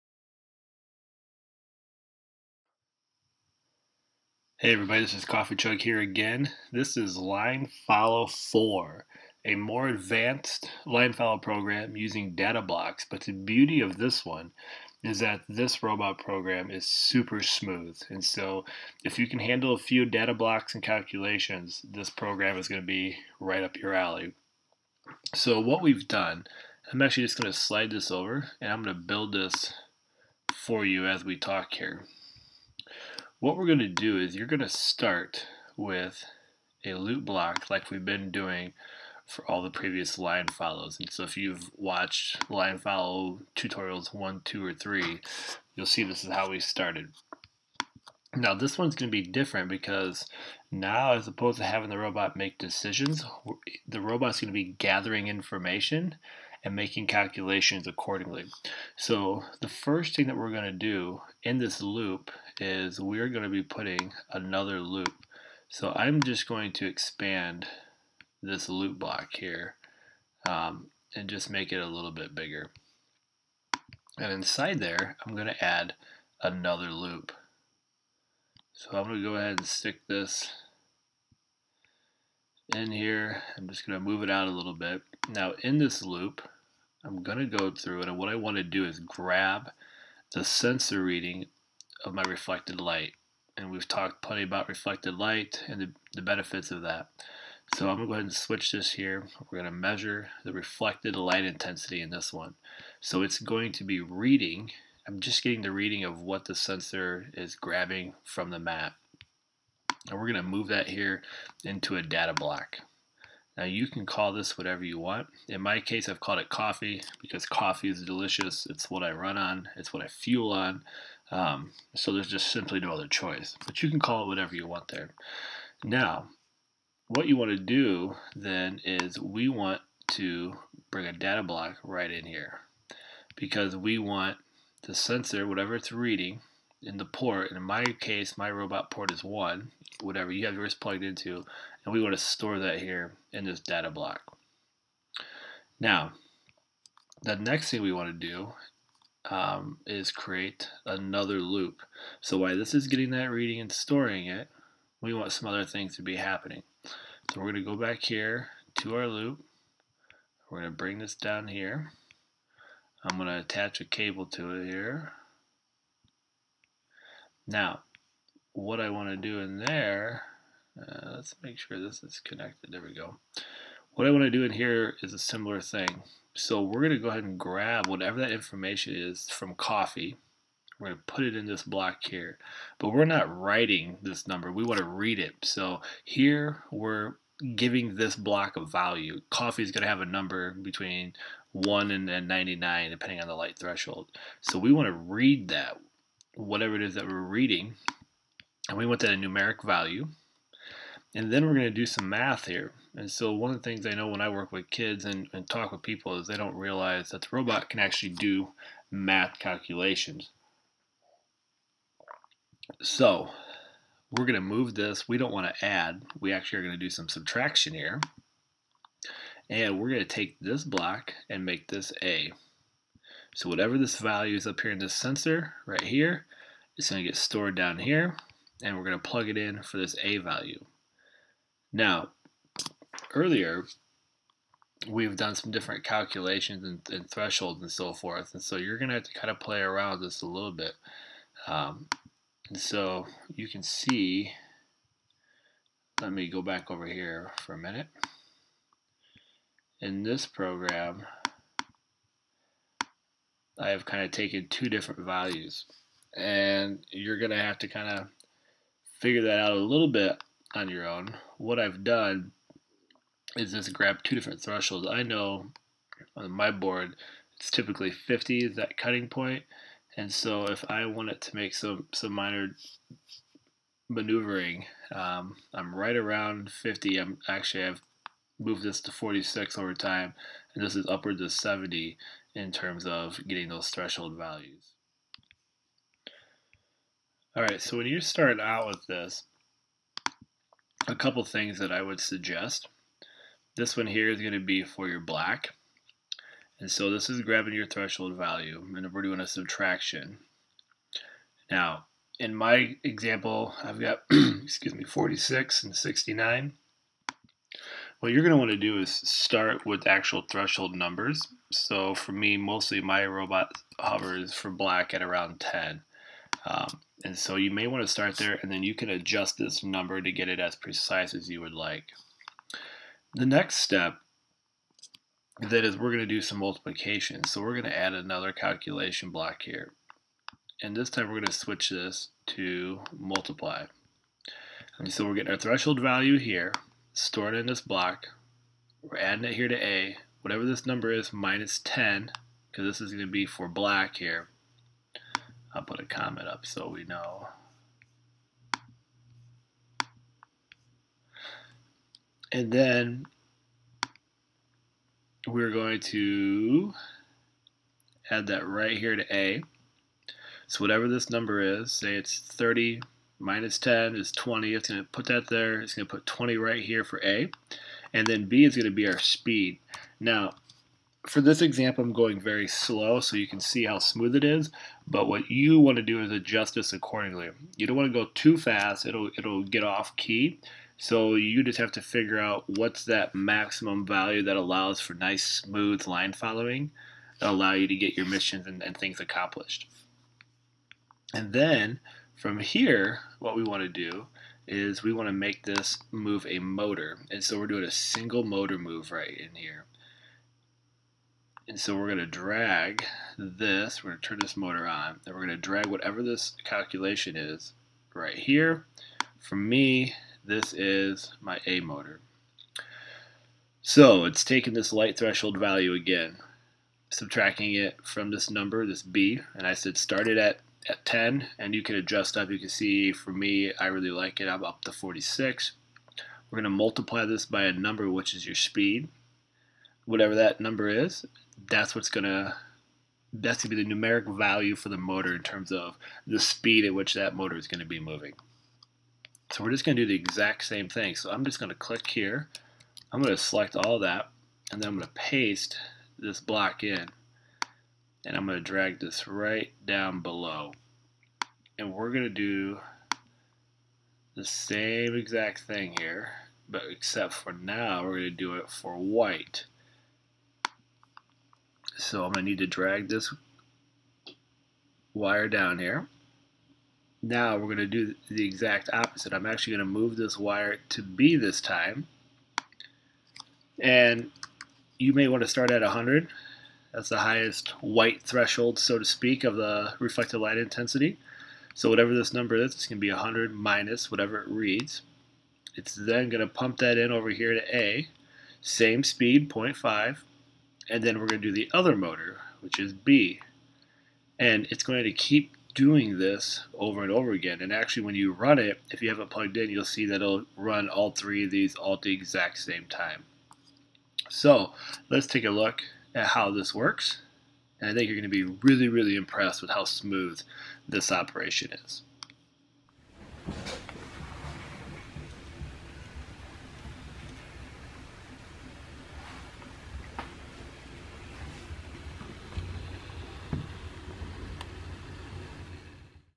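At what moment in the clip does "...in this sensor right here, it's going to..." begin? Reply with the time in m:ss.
3:44.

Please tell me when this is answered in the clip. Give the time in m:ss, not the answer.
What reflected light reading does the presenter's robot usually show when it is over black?
5:13.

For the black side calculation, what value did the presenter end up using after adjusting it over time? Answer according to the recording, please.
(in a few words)
46.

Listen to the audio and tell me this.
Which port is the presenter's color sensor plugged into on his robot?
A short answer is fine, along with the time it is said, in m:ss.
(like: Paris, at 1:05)
1, at 2:18.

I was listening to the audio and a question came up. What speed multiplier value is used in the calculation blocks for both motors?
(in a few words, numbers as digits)
0.5.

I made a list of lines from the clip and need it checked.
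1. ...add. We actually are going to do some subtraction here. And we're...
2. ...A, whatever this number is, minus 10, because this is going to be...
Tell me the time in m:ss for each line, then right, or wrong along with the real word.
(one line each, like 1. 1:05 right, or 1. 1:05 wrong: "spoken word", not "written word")
1. 3:35 right
2. 5:39 right.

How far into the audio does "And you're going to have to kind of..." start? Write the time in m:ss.
4:16.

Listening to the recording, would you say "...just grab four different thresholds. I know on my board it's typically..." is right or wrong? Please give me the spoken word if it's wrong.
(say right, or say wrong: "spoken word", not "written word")
wrong: "two", not "four".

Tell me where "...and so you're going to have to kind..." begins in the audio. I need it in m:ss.
3:58.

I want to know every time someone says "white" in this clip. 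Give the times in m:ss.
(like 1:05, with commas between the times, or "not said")
7:38, 7:57.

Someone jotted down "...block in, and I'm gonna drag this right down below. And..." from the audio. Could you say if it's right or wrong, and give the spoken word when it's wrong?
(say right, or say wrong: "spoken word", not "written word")
right.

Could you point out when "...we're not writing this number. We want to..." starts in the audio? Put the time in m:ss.
3:02.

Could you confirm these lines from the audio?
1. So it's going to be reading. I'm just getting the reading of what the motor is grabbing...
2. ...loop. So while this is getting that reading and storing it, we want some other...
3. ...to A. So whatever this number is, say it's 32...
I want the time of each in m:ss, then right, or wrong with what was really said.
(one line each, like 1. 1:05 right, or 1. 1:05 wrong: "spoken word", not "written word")
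1. 1:42 wrong: "sensor", not "motor"
2. 2:31 right
3. 5:58 wrong: "30", not "32".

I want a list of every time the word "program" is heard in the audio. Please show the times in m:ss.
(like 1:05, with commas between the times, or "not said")
0:11, 0:16, 0:22, 4:10.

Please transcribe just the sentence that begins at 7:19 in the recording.
So we're just gonna do the exact same thing.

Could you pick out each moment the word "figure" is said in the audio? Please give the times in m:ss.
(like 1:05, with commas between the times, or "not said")
4:18, 6:21.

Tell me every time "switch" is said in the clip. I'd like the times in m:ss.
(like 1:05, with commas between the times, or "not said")
1:38, 5:31.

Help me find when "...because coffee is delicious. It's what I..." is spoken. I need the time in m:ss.
1:57.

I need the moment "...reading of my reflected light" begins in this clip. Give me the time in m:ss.
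1:31.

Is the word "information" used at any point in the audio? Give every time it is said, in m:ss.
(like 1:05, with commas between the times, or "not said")
0:55, 2:58.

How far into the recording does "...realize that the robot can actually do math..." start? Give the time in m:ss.
3:26.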